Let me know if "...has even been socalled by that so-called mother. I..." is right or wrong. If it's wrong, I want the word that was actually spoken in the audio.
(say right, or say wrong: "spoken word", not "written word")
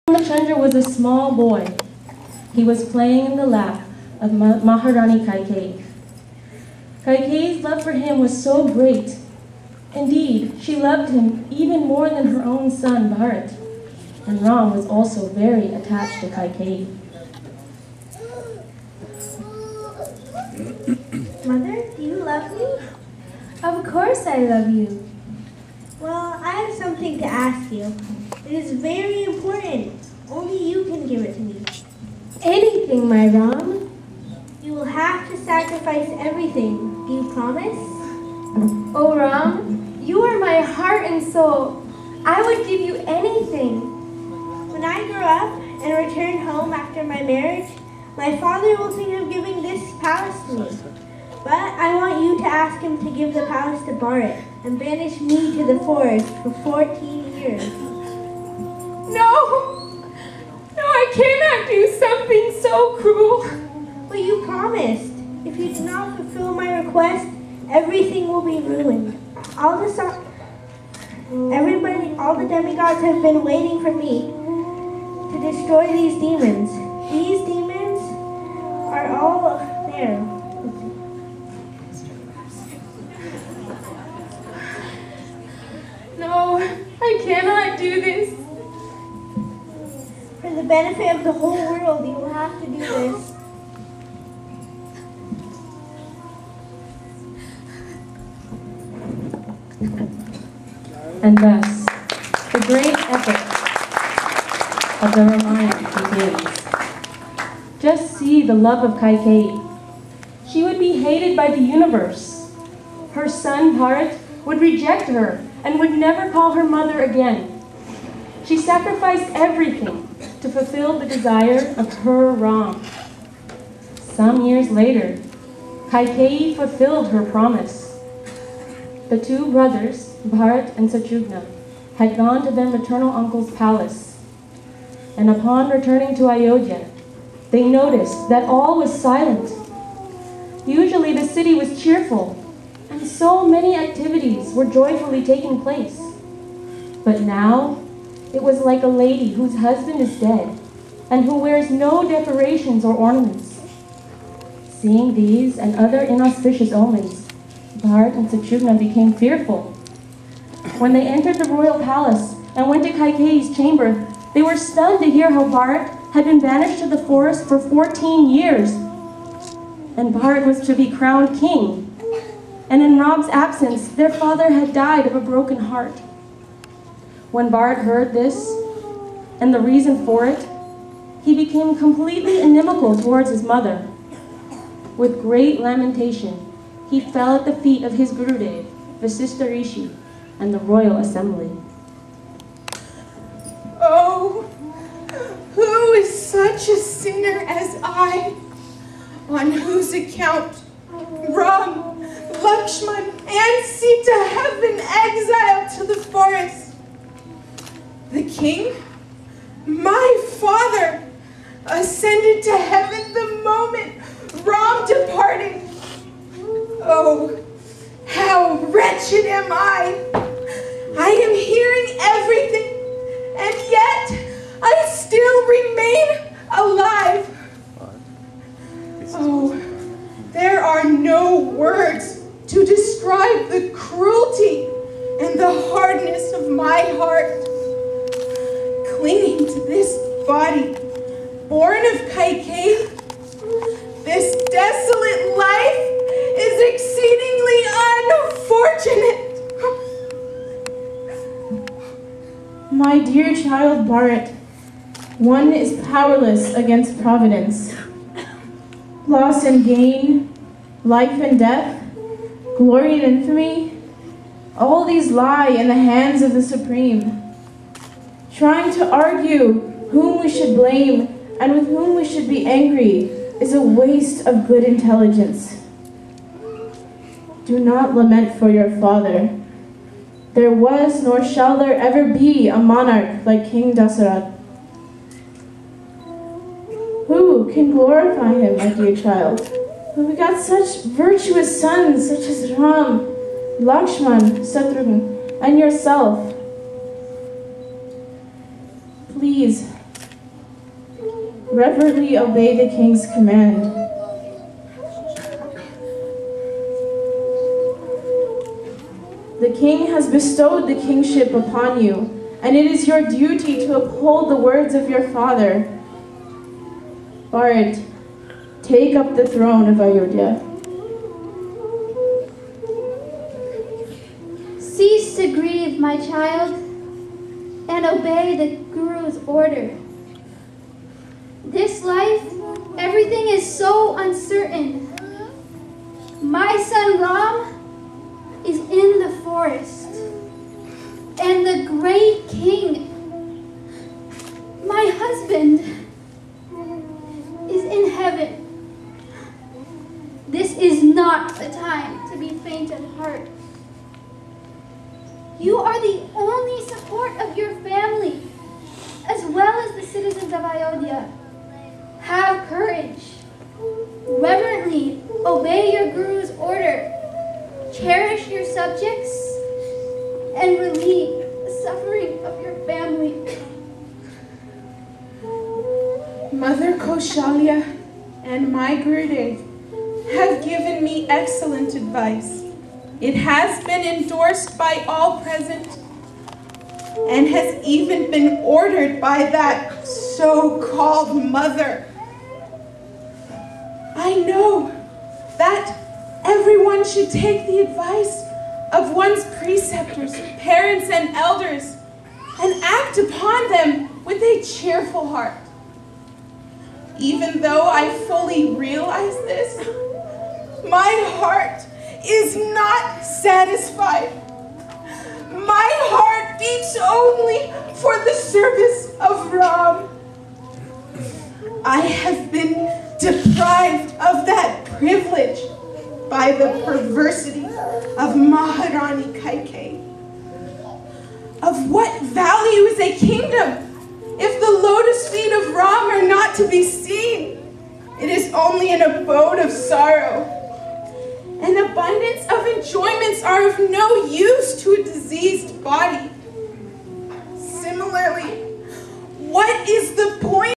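wrong: "ordered", not "socalled".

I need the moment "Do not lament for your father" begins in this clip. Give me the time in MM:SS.
04:37.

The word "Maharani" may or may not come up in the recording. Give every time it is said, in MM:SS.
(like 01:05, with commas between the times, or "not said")
00:04, 07:08.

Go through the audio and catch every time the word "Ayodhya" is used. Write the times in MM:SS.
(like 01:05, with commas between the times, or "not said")
02:16, 05:19, 06:00.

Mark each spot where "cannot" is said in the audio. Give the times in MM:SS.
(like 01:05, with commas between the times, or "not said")
01:01, 01:27.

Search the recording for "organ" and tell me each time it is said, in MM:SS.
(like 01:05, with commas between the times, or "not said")
not said.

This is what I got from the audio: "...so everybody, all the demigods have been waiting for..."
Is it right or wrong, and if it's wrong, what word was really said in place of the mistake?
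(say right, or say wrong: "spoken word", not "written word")
right.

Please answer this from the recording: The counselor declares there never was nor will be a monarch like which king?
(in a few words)
King Dasarath.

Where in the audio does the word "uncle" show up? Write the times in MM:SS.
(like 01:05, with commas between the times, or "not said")
02:13.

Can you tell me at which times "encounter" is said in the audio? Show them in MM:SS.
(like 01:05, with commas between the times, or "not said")
not said.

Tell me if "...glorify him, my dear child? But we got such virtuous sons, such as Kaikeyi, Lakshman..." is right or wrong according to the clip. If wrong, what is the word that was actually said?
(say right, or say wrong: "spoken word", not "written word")
wrong: "Ram", not "Kaikeyi".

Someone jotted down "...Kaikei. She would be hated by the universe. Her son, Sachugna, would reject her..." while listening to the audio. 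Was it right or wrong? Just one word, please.
wrong.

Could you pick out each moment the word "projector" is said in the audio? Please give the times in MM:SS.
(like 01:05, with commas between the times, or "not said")
not said.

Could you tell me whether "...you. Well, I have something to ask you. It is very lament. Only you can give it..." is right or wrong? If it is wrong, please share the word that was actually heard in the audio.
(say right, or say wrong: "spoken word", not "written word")
wrong: "important", not "lament".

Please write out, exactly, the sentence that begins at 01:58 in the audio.
She sacrificed everything to fulfill the desire of her Ram, Some years later, Kaikei fulfilled her promise.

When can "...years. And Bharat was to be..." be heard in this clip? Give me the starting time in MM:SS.
02:48.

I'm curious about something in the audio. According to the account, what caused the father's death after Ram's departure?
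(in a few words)
A broken heart.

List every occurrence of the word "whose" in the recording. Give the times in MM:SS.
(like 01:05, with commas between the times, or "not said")
02:29, 03:19.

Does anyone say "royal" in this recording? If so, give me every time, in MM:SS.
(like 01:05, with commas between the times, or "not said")
02:41, 03:10.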